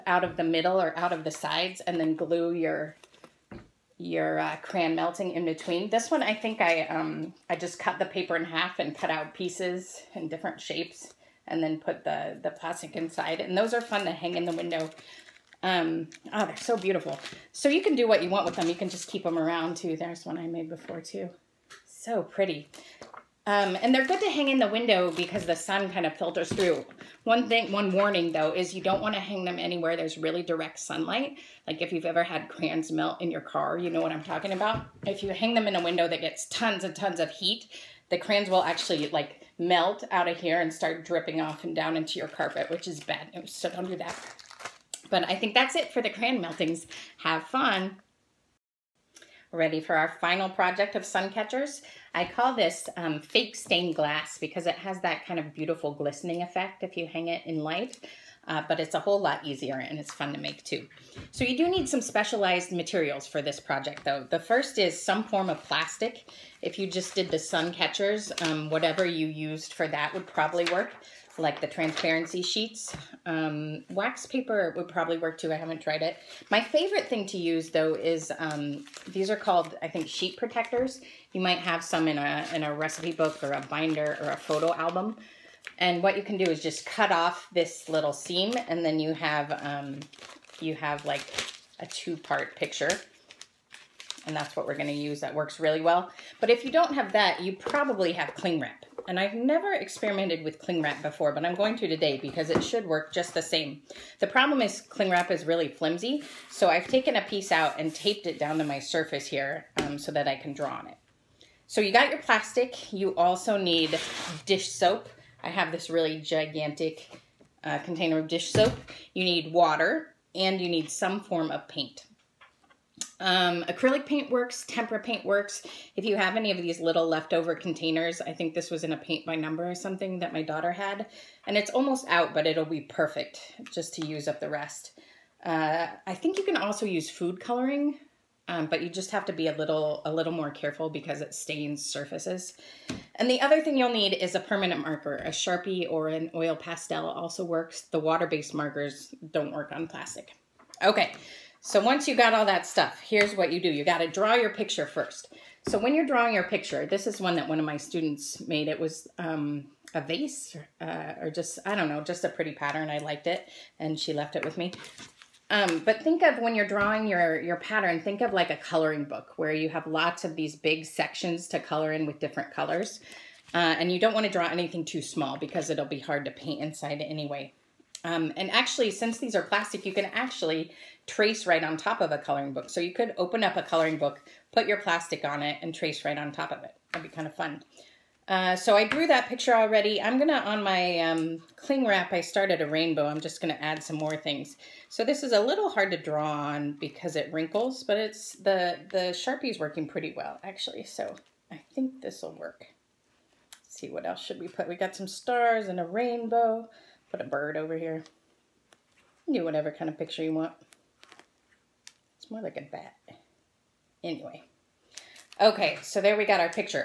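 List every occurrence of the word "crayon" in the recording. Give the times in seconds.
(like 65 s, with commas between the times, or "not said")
4 s, 32 s, 38 s, 46 s.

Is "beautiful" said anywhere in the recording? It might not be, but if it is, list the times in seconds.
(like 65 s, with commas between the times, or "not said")
16 s, 55 s.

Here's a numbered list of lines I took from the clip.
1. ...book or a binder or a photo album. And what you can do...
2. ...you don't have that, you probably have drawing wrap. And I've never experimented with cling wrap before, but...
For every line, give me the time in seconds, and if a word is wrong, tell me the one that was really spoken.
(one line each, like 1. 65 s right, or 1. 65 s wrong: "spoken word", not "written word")
1. 83 s right
2. 96 s wrong: "cling", not "drawing".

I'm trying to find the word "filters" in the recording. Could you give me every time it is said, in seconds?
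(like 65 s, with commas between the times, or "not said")
26 s.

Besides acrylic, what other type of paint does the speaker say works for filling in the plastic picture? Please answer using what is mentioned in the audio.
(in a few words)
tempera paint.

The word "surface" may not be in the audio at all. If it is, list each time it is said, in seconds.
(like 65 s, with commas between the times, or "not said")
108 s, 141 s.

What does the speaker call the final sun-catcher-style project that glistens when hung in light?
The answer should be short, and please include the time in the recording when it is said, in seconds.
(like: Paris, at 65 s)
fake stained glass, at 53 s.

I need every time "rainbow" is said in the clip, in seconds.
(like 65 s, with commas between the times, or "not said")
192 s, 205 s.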